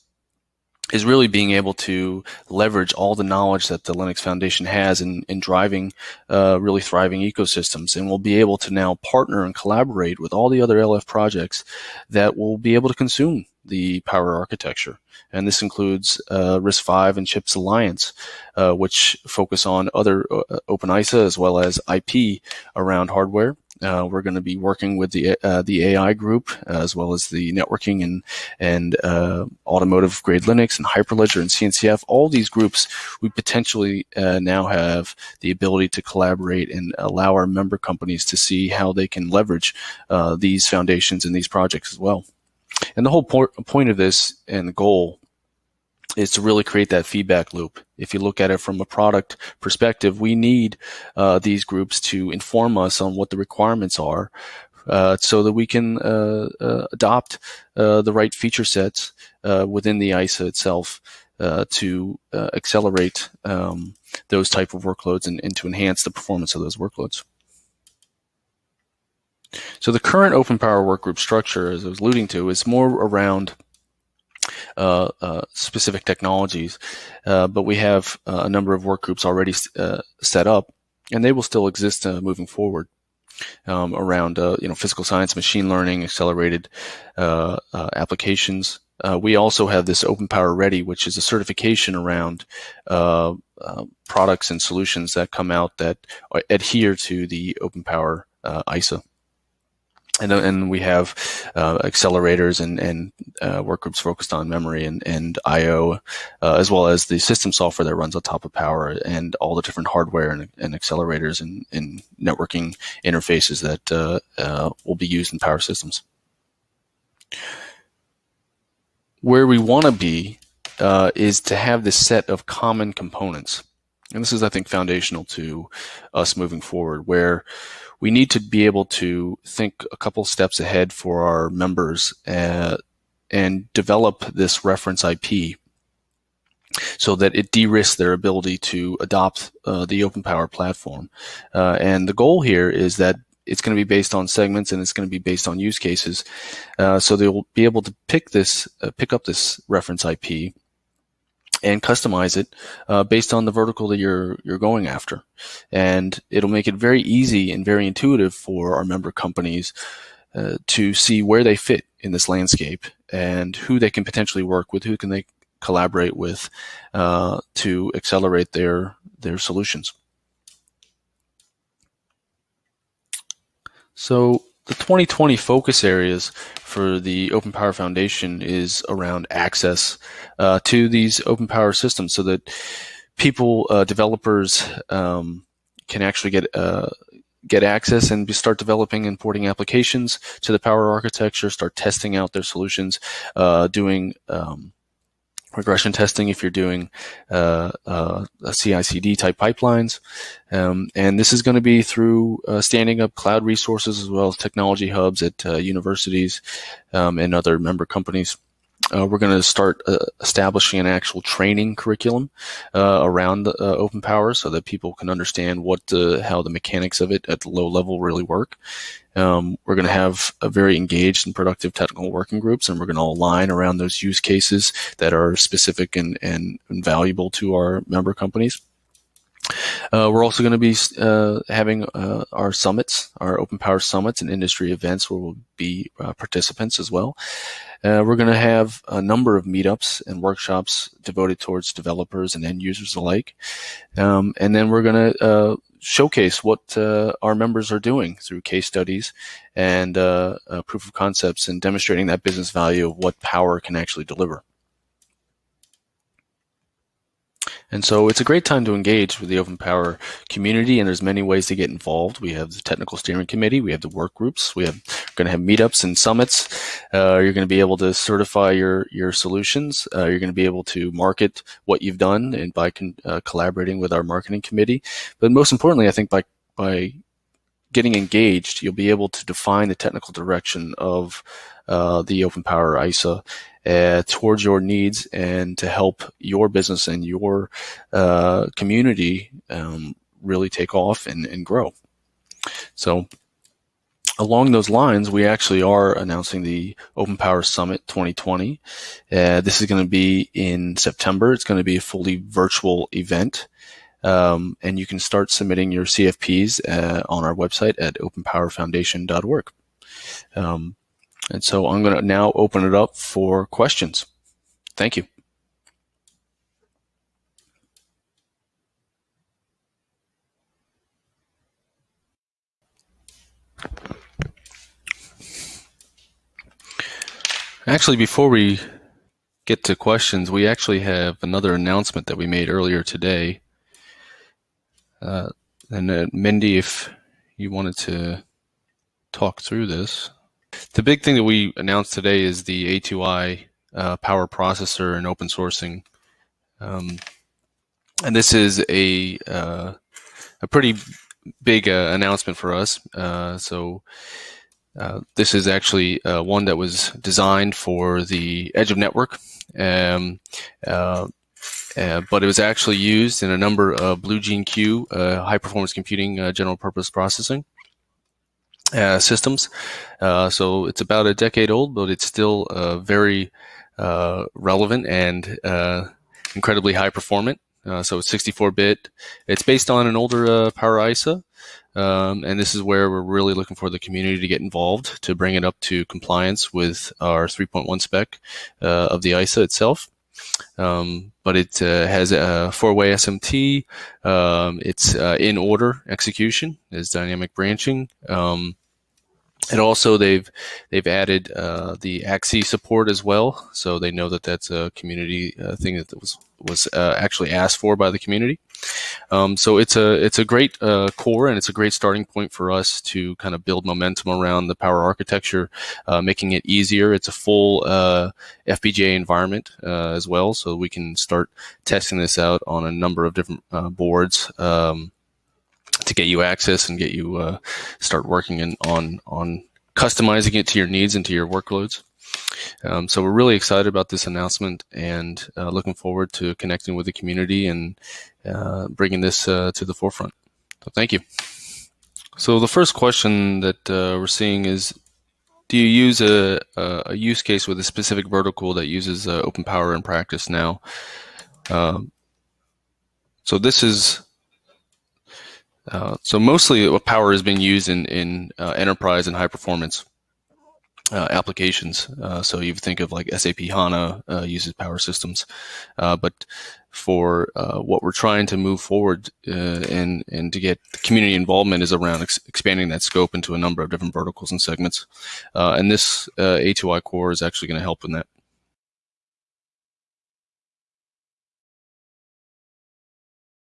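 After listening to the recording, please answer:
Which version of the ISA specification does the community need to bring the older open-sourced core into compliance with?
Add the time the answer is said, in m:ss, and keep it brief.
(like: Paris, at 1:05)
3.1, at 6:27.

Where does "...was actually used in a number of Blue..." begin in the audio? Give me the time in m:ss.
6:02.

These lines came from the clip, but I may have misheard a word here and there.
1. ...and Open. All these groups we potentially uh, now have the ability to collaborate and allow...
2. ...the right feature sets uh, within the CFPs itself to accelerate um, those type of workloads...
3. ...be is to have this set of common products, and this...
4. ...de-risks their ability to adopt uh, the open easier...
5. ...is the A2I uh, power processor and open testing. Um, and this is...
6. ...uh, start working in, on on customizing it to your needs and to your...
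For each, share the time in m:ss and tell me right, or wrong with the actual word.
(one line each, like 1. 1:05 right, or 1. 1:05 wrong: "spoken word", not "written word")
1. 0:31 wrong: "CNCF", not "Open"
2. 0:58 wrong: "ISA", not "CFPs"
3. 1:59 wrong: "components", not "products"
4. 2:17 wrong: "power", not "easier"
5. 5:42 wrong: "sourcing", not "testing"
6. 7:07 right.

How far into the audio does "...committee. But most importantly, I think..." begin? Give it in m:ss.
4:34.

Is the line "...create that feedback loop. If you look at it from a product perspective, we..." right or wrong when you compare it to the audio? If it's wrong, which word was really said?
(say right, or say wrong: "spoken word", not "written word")
right.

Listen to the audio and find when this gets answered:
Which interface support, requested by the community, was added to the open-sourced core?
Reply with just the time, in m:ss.
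6:42.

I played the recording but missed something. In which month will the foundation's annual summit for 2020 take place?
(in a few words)
September.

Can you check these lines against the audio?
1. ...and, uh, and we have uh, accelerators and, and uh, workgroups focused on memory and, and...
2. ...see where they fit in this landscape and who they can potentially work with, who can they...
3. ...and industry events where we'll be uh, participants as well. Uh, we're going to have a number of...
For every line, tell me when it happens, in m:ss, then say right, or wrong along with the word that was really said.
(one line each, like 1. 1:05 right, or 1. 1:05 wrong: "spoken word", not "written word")
1. 1:40 right
2. 2:40 right
3. 3:54 right.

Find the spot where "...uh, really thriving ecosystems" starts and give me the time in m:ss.
0:06.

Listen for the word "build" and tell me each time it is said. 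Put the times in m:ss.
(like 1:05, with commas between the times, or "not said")
6:53.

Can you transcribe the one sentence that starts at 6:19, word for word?
It's based on an older Power ISA.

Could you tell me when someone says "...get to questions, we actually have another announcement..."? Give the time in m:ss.
5:29.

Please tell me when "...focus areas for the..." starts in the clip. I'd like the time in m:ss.
2:55.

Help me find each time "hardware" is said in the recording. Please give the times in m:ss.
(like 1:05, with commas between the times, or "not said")
0:23, 1:49.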